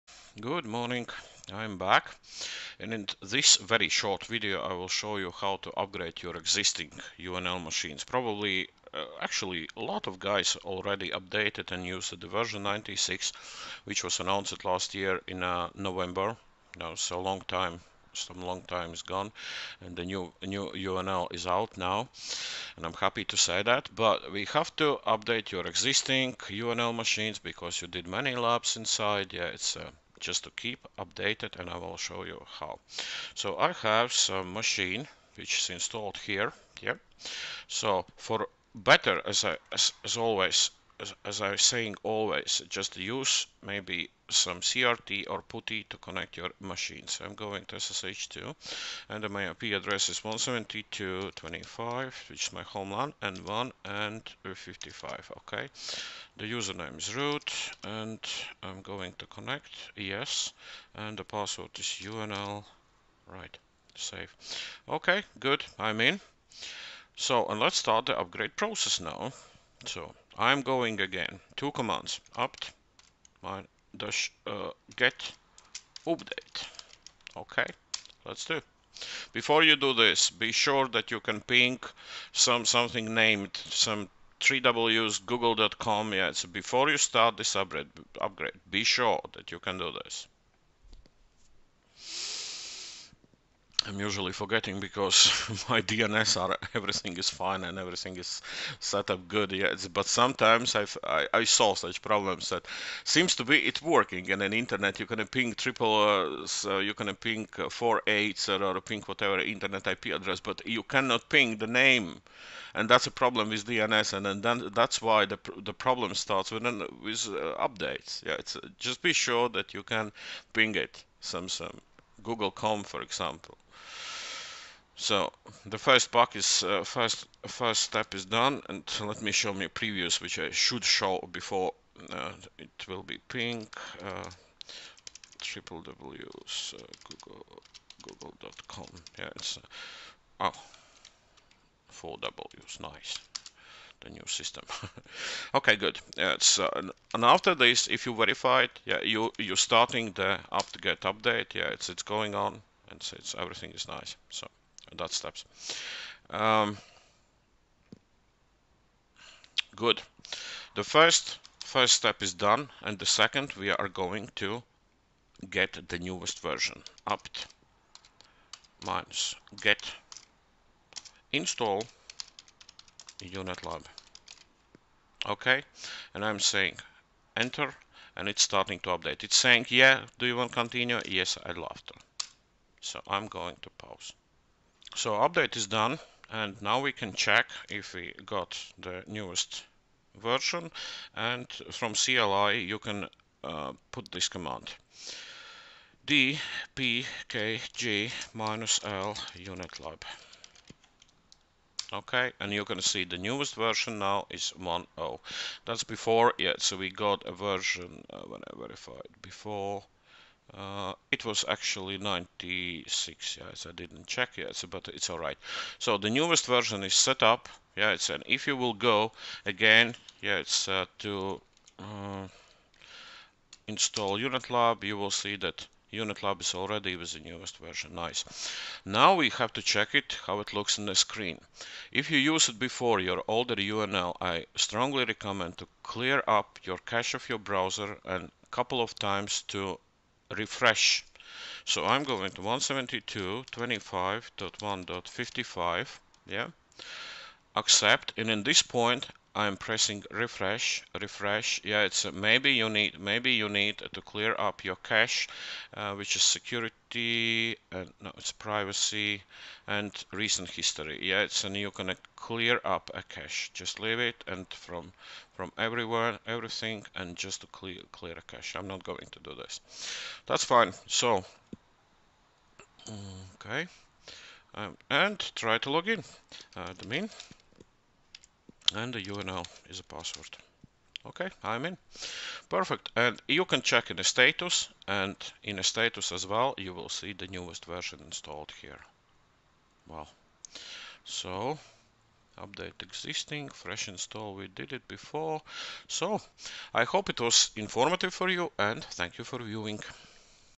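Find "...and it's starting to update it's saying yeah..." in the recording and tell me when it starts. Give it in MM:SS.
02:58.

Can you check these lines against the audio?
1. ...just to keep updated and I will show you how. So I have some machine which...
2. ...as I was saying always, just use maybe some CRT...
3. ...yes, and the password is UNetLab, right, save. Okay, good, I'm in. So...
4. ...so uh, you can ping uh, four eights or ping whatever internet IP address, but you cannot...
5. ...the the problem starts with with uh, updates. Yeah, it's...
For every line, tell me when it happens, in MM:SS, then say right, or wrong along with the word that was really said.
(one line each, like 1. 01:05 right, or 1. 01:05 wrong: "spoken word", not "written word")
1. 00:30 right
2. 00:41 right
3. 00:59 wrong: "UNL", not "UNetLab"
4. 01:46 right
5. 01:55 right.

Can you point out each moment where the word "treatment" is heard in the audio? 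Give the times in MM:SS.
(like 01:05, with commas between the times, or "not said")
not said.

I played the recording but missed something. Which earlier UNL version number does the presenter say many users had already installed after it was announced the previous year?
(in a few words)
96.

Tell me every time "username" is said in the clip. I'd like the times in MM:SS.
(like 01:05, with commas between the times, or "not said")
00:56.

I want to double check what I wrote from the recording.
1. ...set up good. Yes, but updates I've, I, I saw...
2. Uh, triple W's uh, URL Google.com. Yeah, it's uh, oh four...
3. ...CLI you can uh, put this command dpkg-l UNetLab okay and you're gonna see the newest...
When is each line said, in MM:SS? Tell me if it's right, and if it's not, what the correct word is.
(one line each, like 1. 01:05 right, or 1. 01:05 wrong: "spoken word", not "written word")
1. 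01:38 wrong: "sometimes", not "updates"
2. 02:14 wrong: "Google", not "URL"
3. 03:11 right.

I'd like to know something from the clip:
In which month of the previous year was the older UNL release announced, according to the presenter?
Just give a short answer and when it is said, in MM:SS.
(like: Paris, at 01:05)
November, at 00:15.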